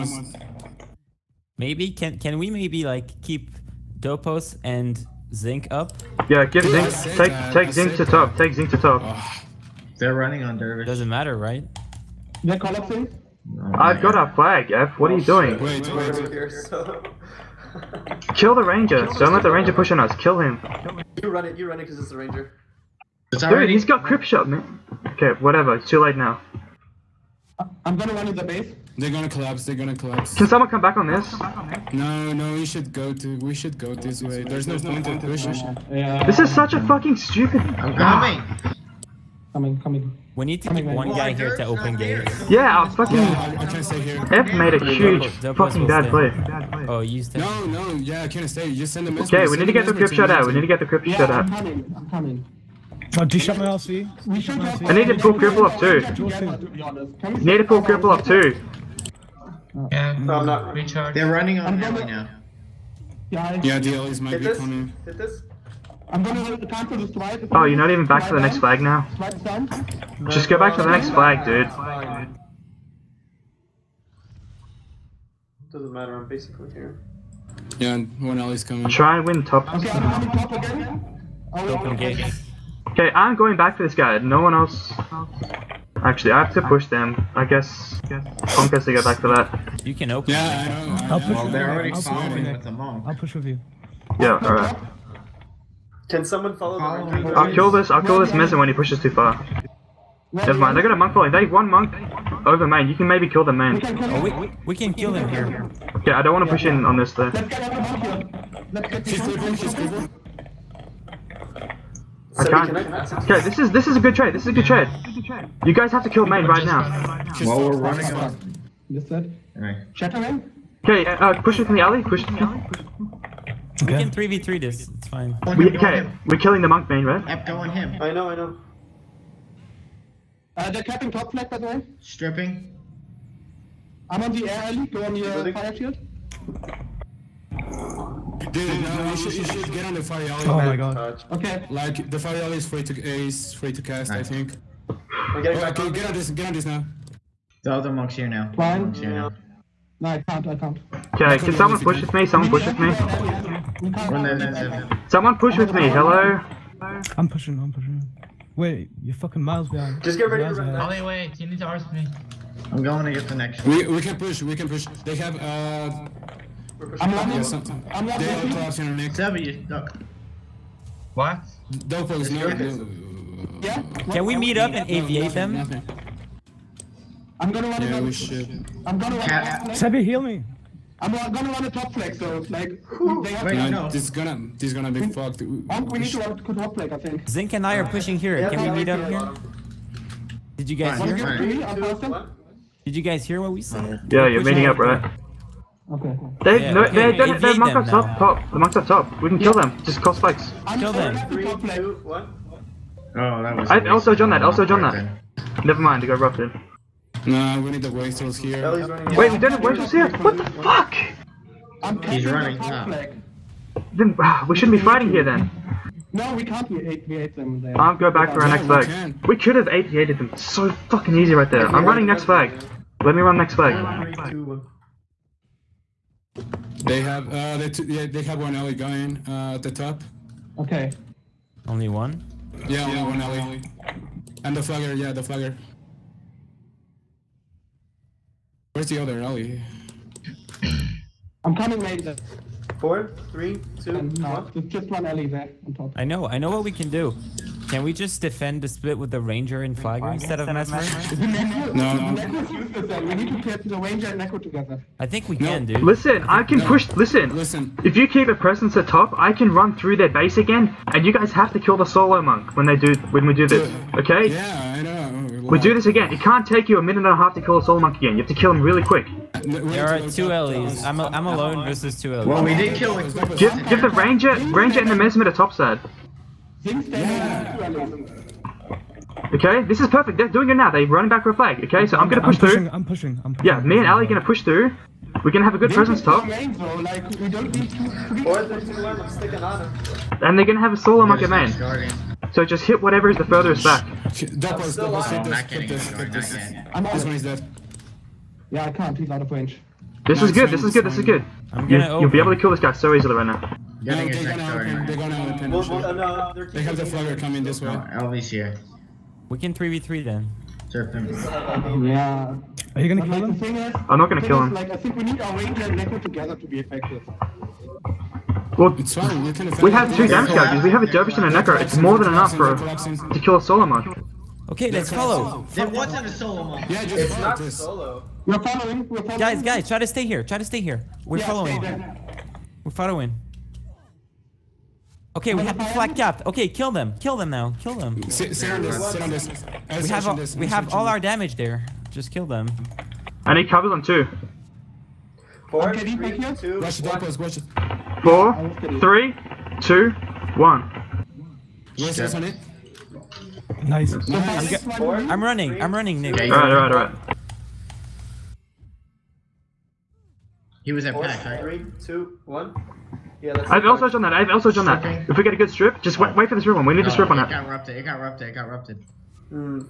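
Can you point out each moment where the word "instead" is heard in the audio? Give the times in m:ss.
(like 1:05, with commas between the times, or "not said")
4:10.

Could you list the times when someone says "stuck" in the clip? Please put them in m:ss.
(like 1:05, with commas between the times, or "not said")
2:49.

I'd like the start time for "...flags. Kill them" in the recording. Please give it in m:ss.
3:20.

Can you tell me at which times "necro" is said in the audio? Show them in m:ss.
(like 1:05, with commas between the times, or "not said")
4:14, 5:15, 5:21.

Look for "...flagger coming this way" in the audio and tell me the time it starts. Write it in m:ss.
5:06.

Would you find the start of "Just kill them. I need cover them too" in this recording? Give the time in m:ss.
5:41.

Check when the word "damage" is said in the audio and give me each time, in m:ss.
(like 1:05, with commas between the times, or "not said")
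5:20, 5:40.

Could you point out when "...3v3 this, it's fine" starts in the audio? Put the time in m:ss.
2:04.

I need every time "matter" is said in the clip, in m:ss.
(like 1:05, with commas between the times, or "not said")
0:11, 1:15.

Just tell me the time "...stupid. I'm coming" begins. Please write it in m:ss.
0:37.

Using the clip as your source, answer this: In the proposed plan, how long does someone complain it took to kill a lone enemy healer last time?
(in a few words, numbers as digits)
a minute and a half.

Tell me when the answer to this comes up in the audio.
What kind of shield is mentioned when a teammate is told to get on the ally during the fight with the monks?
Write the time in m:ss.
2:15.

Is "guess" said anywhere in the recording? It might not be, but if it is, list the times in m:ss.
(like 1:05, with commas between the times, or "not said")
1:27.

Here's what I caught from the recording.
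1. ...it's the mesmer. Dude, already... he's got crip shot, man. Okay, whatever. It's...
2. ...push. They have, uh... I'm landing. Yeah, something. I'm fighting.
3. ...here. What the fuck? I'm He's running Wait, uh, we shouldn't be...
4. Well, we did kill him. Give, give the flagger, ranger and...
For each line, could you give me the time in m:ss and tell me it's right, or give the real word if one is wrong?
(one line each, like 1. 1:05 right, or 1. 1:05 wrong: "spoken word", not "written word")
1. 0:21 wrong: "ranger", not "mesmer"
2. 2:44 wrong: "landing", not "fighting"
3. 3:29 wrong: "Then", not "Wait"
4. 4:32 wrong: "ranger", not "flagger".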